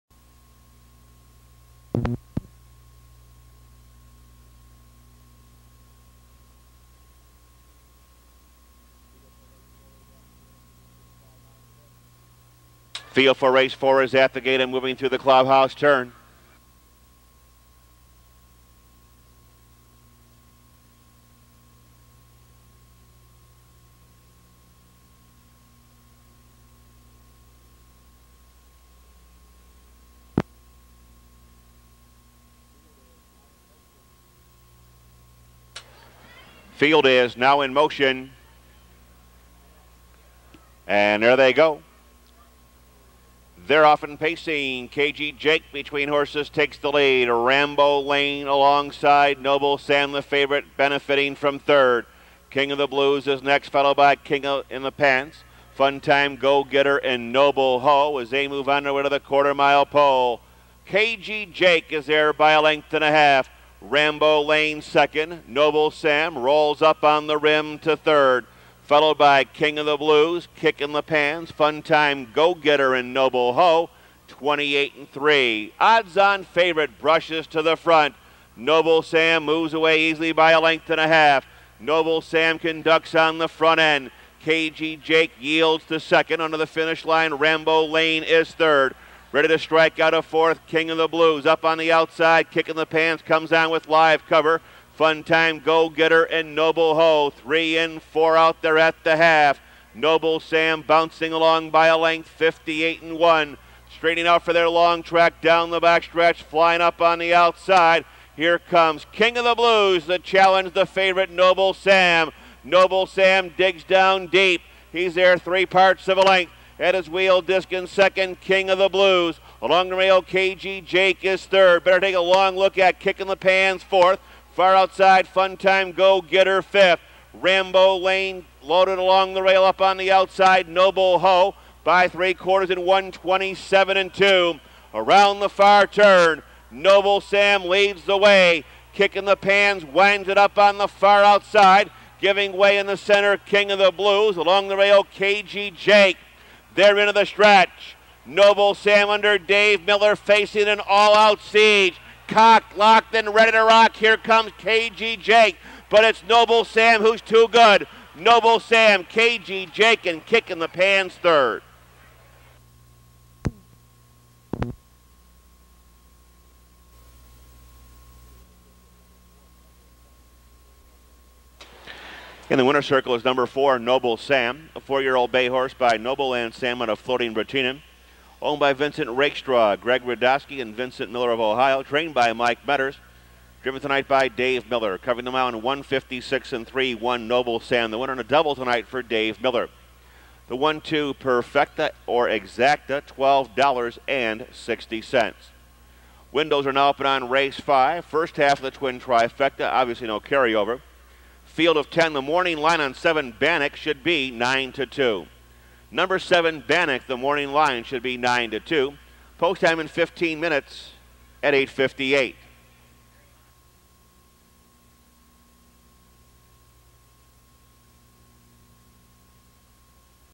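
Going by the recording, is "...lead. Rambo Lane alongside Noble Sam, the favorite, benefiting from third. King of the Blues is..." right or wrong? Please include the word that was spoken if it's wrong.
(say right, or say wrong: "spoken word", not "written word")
right.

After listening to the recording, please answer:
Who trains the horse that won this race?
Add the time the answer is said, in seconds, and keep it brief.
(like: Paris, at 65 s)
Mike Metters, at 181 s.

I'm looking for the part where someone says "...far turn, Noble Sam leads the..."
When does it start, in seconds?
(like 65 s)
135 s.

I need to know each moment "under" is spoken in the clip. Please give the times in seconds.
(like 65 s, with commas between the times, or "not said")
86 s, 149 s.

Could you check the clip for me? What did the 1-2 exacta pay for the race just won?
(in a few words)
$12.60.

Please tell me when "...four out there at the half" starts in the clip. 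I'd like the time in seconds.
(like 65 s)
98 s.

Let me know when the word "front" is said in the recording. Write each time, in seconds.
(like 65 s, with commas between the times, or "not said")
77 s, 83 s.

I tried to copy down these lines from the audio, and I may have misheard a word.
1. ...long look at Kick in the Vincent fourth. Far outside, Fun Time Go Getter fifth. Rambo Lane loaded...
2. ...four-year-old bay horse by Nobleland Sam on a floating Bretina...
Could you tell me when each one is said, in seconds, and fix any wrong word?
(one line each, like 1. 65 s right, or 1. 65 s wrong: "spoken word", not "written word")
1. 122 s wrong: "Pants", not "Vincent"
2. 174 s right.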